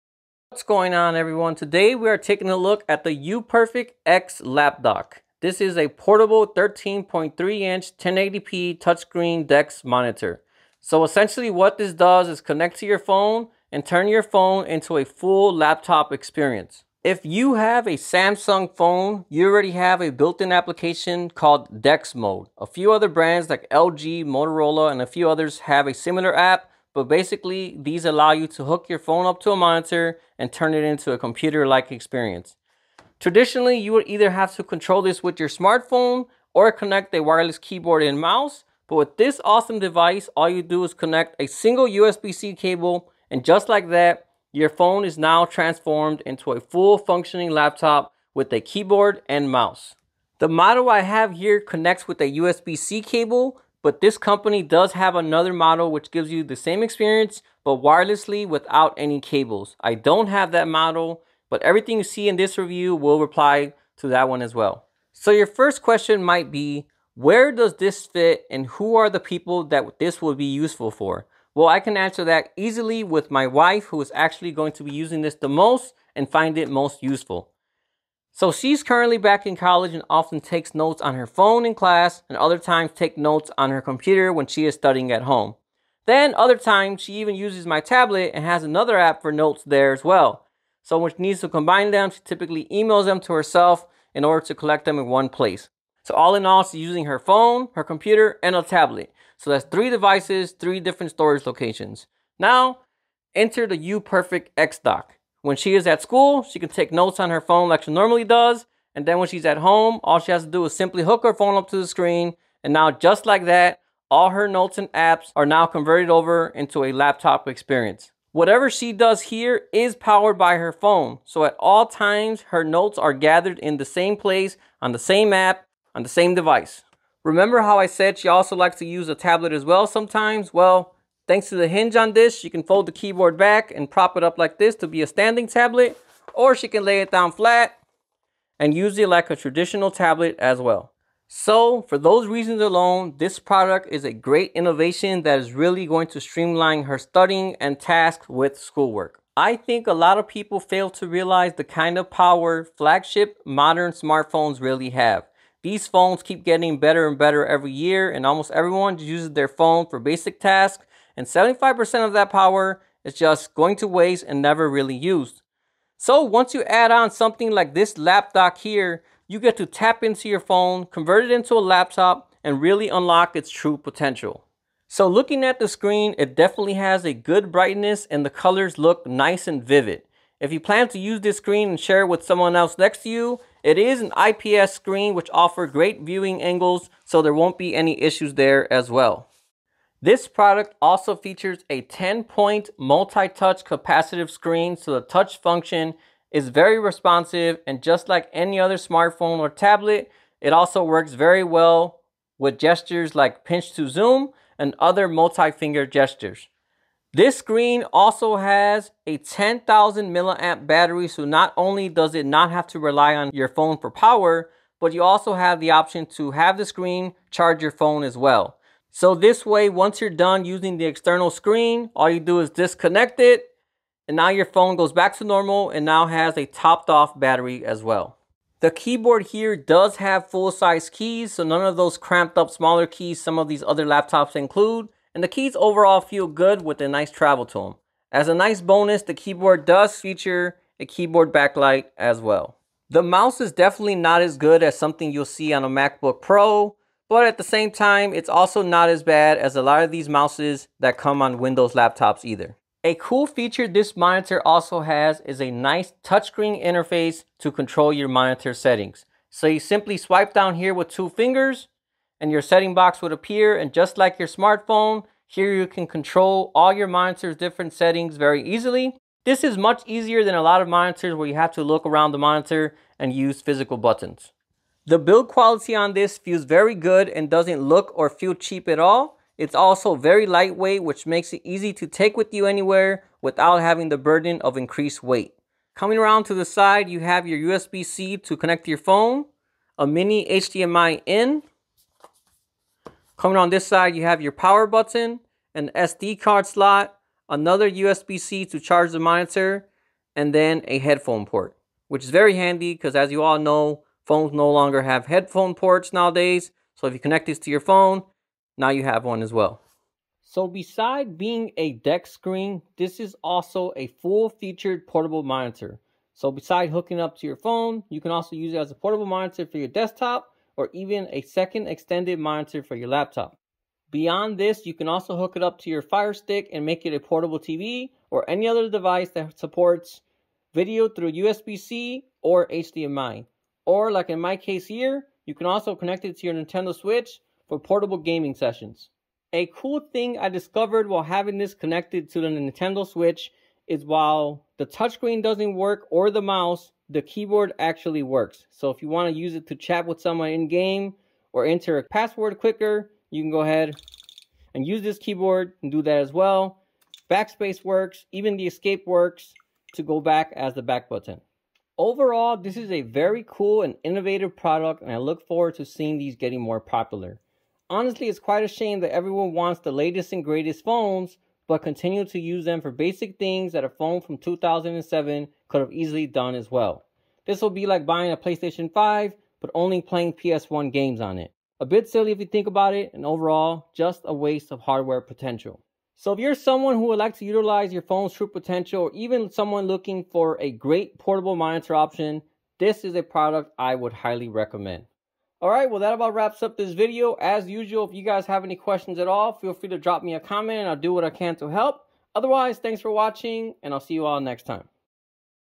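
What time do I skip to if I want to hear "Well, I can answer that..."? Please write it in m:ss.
1:11.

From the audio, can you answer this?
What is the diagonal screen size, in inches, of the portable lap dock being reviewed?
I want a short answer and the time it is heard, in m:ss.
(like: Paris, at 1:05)
13.3 inches, at 0:06.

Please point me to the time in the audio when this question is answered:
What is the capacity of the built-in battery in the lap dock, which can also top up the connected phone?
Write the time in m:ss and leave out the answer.
3:29.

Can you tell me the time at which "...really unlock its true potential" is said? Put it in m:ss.
2:52.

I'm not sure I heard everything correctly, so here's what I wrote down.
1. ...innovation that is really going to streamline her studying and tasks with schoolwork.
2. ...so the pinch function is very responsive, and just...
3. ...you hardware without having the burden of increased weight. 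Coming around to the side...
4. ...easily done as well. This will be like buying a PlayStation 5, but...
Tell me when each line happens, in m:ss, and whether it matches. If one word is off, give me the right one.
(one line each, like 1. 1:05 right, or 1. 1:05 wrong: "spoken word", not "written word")
1. 2:24 right
2. 3:14 wrong: "touch", not "pinch"
3. 4:42 wrong: "anywhere", not "hardware"
4. 6:15 right.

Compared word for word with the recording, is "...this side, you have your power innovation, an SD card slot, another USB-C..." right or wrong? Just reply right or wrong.
wrong.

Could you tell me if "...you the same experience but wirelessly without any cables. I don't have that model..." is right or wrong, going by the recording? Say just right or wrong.
right.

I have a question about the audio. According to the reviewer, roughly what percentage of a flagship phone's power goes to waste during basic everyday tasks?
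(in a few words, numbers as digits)
75%.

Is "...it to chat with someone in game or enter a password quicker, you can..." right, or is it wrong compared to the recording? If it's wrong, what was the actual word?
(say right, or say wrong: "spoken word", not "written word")
right.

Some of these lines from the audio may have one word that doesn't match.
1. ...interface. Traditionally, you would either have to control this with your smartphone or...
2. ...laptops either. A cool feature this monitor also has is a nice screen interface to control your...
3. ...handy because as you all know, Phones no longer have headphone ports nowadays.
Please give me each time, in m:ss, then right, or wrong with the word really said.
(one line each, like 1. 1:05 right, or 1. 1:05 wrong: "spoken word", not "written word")
1. 0:31 wrong: "experience", not "interface"
2. 4:11 wrong: "touchscreen", not "screen"
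3. 5:02 right.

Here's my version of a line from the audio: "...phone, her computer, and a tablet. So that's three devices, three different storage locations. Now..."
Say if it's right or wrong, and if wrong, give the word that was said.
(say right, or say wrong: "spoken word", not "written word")
right.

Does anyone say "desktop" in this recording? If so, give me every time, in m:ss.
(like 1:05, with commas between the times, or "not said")
5:19.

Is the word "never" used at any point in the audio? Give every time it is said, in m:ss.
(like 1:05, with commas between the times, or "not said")
2:44.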